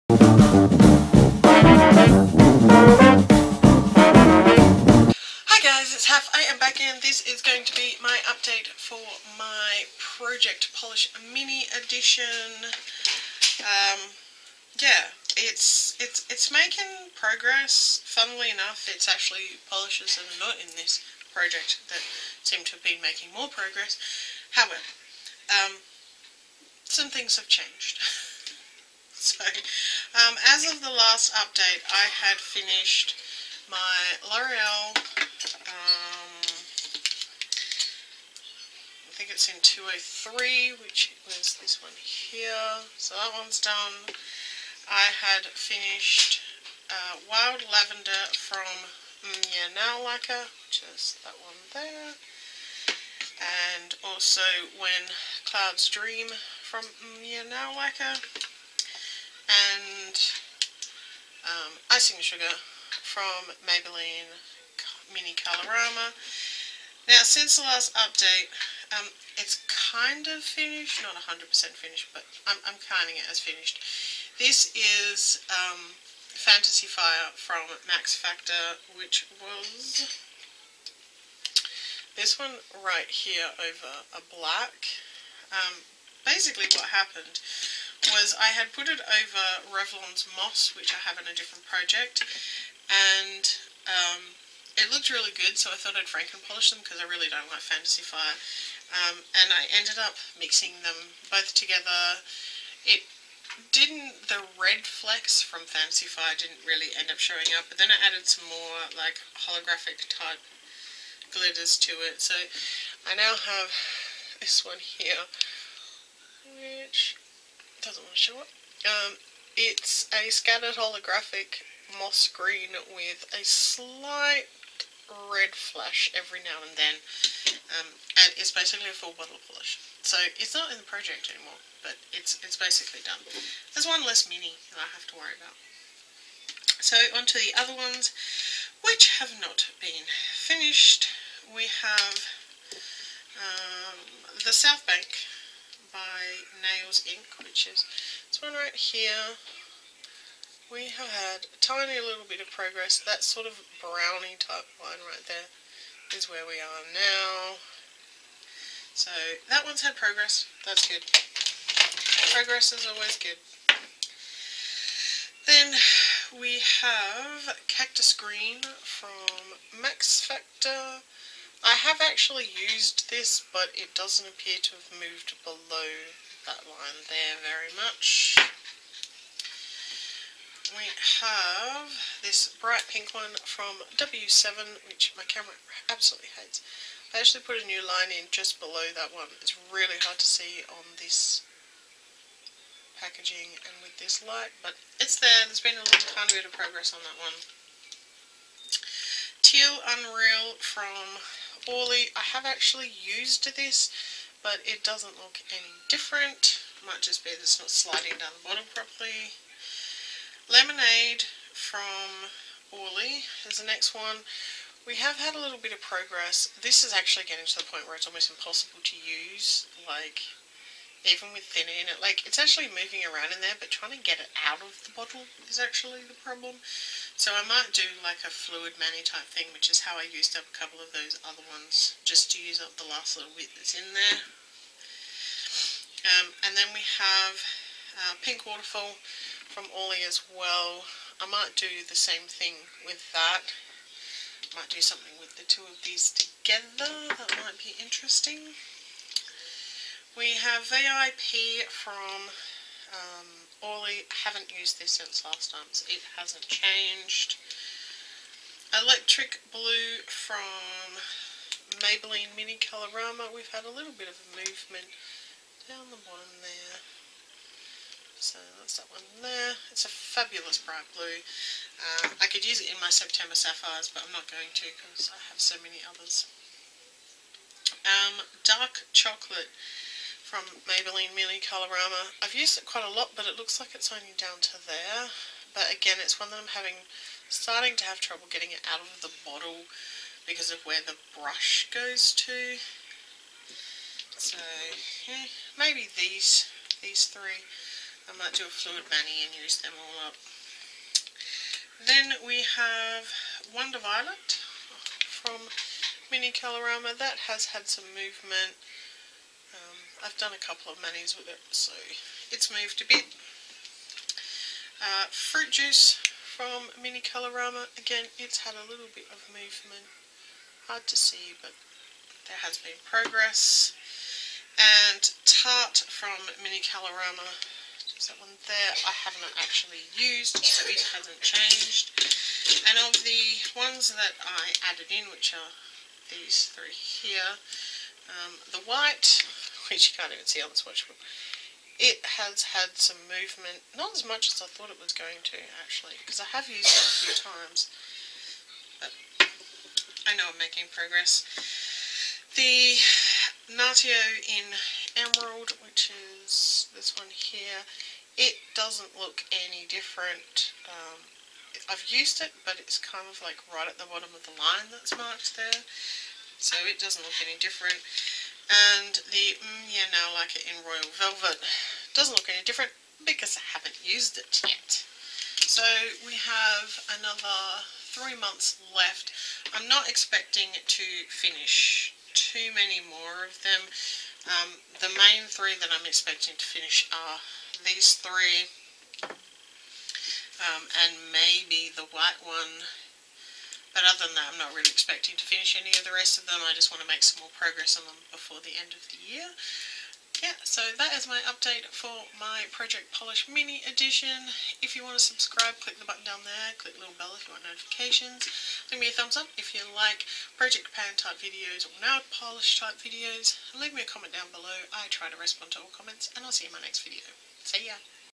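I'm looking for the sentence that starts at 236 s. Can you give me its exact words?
Um, and then we have uh, Pink Waterfall from Orly as well.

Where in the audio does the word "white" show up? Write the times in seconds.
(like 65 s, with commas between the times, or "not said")
338 s, 391 s.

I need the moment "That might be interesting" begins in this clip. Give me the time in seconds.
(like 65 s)
247 s.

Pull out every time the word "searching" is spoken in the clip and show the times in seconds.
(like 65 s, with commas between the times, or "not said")
not said.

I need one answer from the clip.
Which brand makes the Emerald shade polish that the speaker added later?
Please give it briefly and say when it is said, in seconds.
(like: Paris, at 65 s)
Natio, at 353 s.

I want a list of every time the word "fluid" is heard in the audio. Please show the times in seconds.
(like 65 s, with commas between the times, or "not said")
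228 s, 298 s.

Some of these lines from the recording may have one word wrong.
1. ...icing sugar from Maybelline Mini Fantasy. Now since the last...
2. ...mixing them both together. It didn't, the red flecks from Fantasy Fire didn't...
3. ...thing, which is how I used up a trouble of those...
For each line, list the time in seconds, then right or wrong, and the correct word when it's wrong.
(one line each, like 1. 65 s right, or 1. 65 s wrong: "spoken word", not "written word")
1. 61 s wrong: "Colorama", not "Fantasy"
2. 100 s right
3. 229 s wrong: "couple", not "trouble".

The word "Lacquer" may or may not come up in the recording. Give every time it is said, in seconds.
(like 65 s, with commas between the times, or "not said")
50 s, 57 s.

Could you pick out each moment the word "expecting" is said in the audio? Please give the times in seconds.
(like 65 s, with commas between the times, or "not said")
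379 s, 385 s, 394 s.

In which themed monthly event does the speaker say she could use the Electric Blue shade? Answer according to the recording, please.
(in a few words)
September Sapphires.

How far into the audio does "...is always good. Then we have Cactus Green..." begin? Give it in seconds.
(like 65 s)
162 s.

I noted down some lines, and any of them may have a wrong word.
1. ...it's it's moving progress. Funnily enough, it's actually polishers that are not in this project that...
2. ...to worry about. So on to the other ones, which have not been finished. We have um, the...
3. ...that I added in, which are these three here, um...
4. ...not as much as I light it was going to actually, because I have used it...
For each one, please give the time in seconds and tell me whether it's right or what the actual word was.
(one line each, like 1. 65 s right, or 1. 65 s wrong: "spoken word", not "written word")
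1. 16 s wrong: "making", not "moving"
2. 135 s right
3. 333 s right
4. 343 s wrong: "thought", not "light".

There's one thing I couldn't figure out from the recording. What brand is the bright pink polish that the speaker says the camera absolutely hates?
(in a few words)
W7.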